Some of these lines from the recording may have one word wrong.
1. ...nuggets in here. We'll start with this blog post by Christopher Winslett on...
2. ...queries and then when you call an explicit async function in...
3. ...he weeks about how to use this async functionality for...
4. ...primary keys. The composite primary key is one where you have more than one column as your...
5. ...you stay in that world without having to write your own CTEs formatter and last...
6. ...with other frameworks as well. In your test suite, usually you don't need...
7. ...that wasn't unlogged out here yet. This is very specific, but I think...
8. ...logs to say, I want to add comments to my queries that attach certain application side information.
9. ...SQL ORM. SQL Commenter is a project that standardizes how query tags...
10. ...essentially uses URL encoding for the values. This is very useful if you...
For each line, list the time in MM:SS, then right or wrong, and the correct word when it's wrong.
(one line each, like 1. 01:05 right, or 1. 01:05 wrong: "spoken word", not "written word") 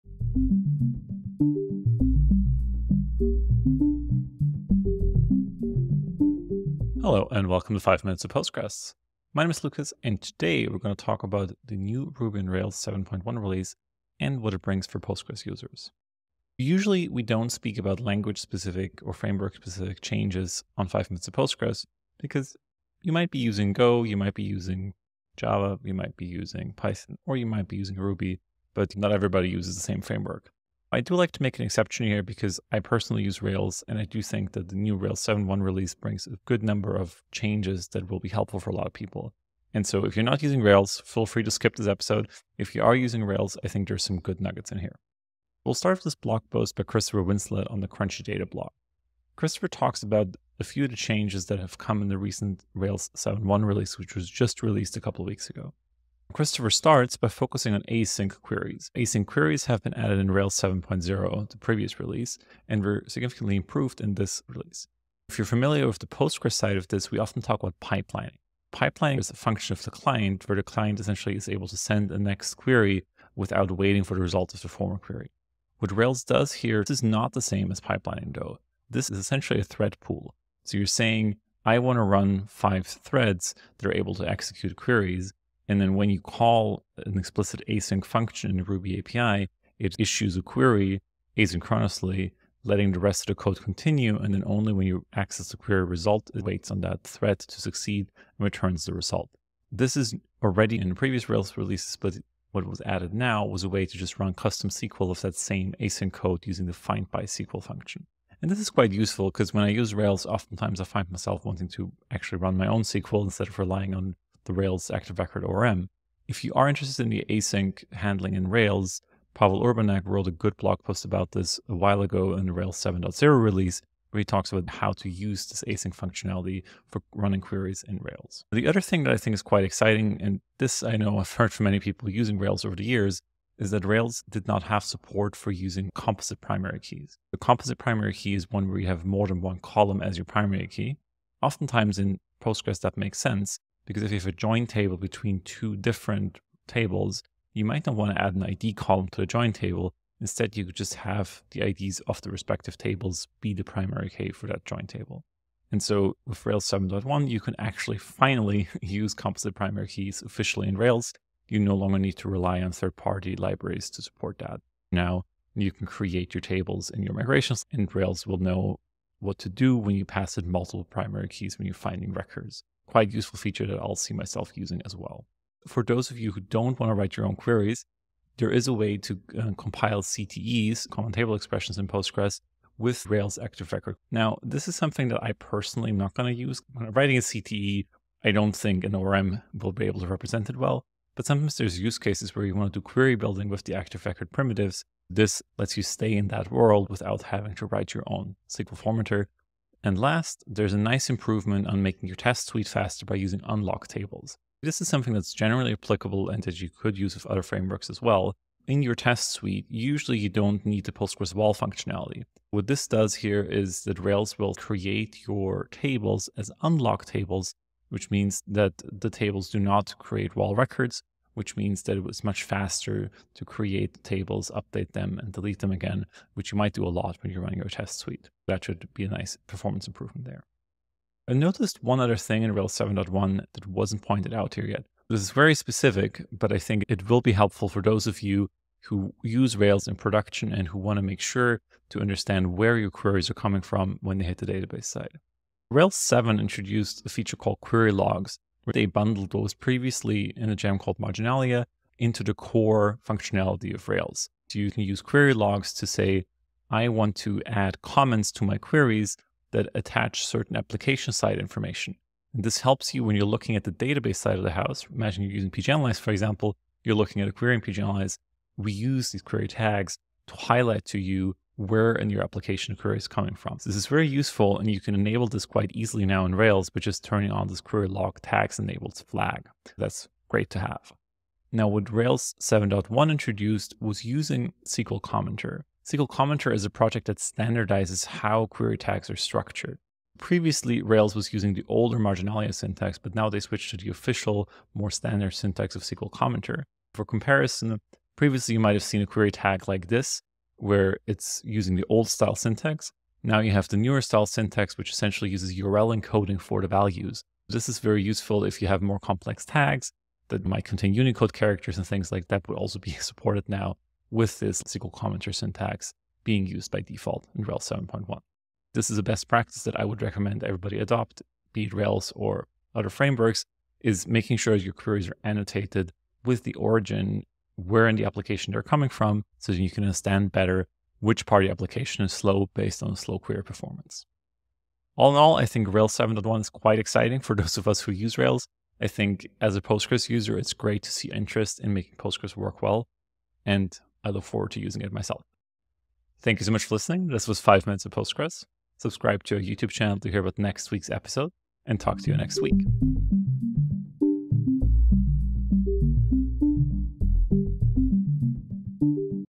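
1. 00:44 right
2. 01:24 right
3. 02:04 wrong: "talks", not "weeks"
4. 02:16 right
5. 03:15 wrong: "SQL", not "CTEs"
6. 03:27 right
7. 03:53 wrong: "pointed", not "unlogged"
8. 04:15 right
9. 04:44 wrong: "Commenter", not "ORM"
10. 05:04 right.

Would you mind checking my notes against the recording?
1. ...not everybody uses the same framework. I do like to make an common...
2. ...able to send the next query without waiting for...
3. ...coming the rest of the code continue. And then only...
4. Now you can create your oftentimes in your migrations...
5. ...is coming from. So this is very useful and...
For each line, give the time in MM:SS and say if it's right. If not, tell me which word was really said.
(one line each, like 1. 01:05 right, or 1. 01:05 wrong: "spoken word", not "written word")
1. 00:28 wrong: "exception", not "common"
2. 01:11 right
3. 01:32 wrong: "letting", not "coming"
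4. 02:44 wrong: "tables", not "oftentimes"
5. 04:32 right.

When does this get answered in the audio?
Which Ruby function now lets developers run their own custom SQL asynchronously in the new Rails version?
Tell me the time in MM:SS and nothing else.
01:46.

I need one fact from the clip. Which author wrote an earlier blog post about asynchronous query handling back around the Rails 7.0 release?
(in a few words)
Pawel Urbanek.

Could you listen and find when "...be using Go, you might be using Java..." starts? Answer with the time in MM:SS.
00:23.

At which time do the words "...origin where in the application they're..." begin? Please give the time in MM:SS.
05:26.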